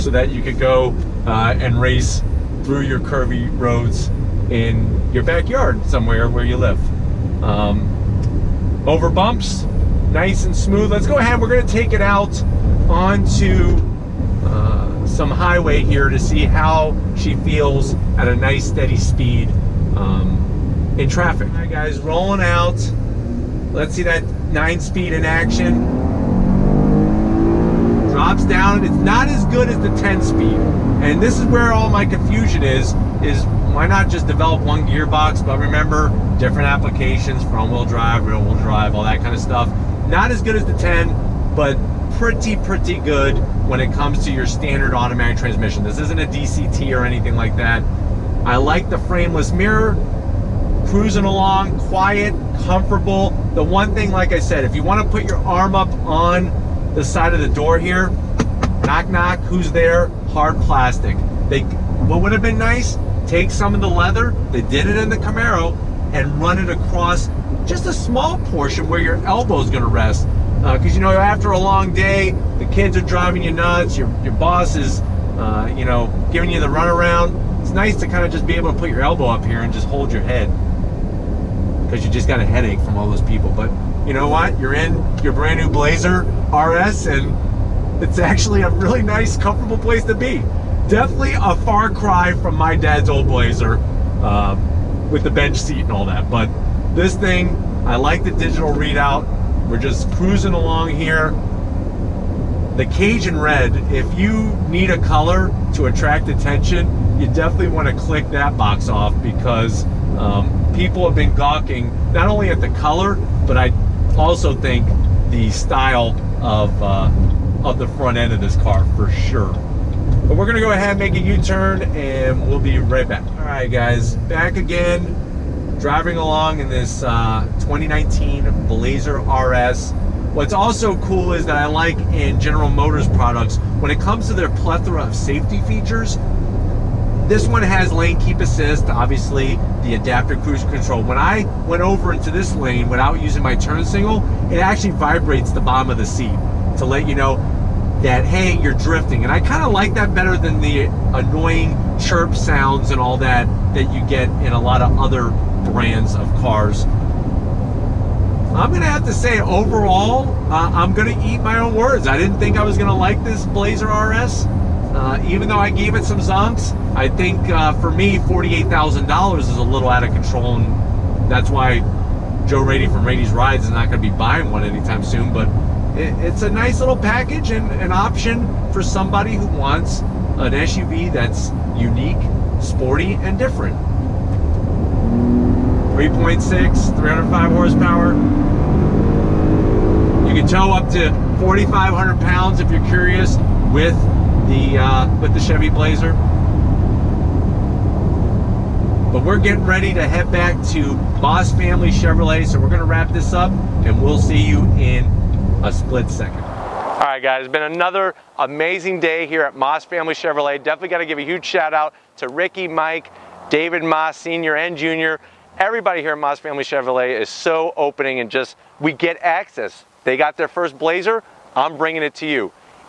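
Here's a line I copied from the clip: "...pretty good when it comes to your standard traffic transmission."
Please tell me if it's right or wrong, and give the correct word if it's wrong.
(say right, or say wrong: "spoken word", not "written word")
wrong: "automatic", not "traffic".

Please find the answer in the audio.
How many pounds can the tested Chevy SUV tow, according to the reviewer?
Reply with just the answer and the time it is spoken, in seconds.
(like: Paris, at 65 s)
4,500, at 191 s.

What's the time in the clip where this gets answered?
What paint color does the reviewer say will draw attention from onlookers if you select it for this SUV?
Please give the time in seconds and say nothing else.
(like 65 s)
102 s.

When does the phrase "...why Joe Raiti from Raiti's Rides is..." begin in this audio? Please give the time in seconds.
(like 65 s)
171 s.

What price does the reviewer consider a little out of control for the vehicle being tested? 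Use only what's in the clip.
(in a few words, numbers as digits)
$48,000.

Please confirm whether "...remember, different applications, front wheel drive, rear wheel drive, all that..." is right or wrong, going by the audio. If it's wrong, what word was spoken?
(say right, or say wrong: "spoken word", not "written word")
right.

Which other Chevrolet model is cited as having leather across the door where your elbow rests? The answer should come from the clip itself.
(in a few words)
Camaro.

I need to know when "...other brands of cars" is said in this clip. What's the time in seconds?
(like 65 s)
154 s.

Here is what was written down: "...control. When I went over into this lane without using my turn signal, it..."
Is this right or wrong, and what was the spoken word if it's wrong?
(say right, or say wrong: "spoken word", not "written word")
right.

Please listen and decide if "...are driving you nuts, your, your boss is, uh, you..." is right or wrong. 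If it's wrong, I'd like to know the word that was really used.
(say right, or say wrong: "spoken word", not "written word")
right.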